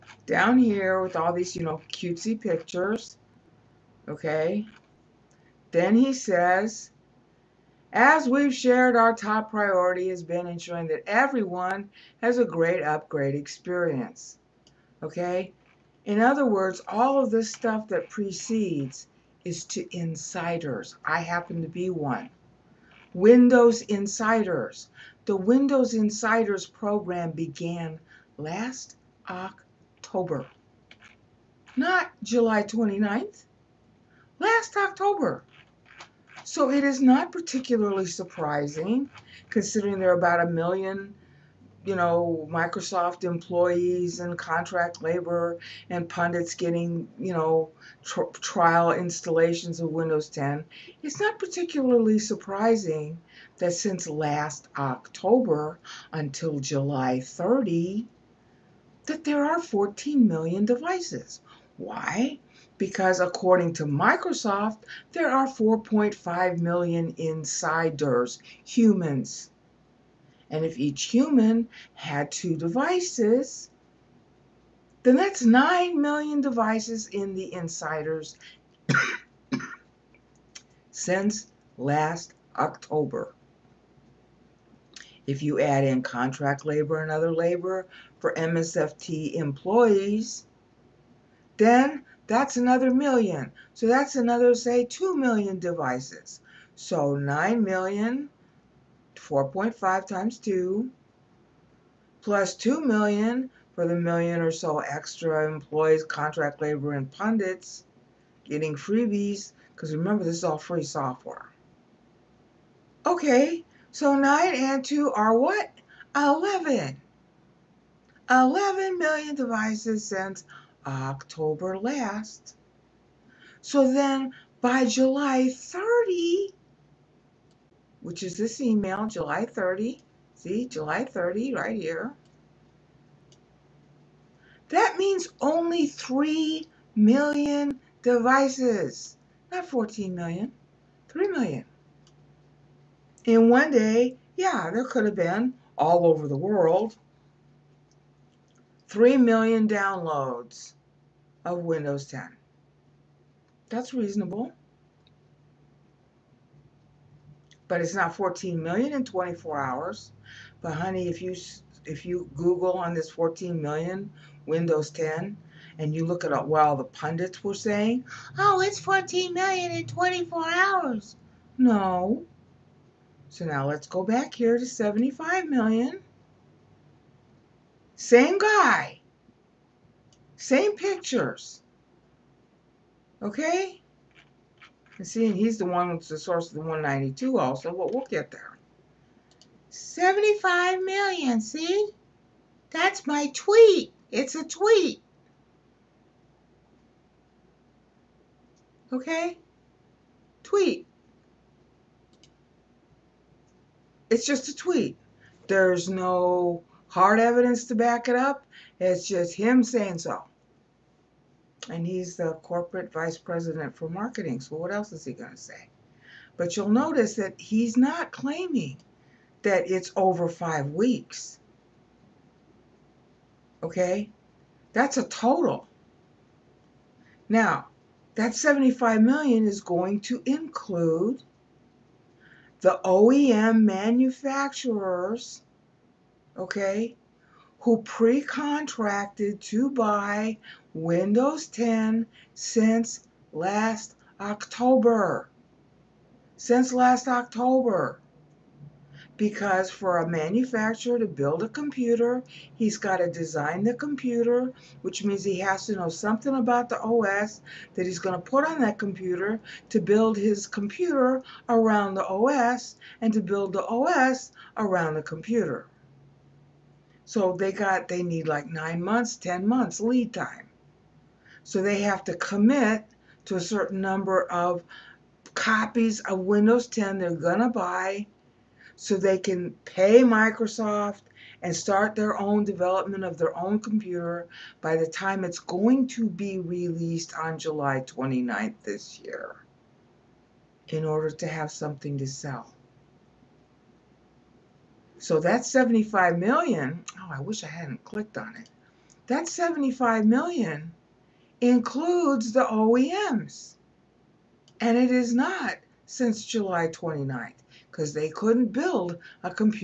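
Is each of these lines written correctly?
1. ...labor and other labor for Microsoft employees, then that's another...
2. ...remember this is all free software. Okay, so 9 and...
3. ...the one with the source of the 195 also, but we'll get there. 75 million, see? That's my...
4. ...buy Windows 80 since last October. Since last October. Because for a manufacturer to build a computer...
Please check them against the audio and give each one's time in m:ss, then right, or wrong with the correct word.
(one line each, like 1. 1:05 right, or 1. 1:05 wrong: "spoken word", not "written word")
1. 1:26 wrong: "MSFT", not "Microsoft"
2. 1:49 right
3. 3:05 wrong: "192", not "195"
4. 3:59 wrong: "10", not "80".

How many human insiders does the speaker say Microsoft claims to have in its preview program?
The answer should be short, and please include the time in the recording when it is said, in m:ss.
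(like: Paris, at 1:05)
4.5 million, at 1:05.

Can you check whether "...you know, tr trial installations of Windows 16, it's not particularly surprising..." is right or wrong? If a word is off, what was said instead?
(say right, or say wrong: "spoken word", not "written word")
wrong: "10", not "16".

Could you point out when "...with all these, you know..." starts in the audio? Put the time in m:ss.
0:01.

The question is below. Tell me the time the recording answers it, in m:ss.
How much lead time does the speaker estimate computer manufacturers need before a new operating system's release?
4:28.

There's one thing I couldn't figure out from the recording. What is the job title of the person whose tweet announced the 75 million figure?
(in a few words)
Corporate vice president for marketing.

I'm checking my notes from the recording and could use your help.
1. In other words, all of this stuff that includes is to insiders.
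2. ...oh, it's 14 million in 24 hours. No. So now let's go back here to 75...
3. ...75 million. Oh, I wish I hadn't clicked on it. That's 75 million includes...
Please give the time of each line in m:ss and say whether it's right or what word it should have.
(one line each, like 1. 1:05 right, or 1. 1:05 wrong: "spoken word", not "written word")
1. 0:16 wrong: "precedes", not "includes"
2. 2:48 right
3. 4:55 right.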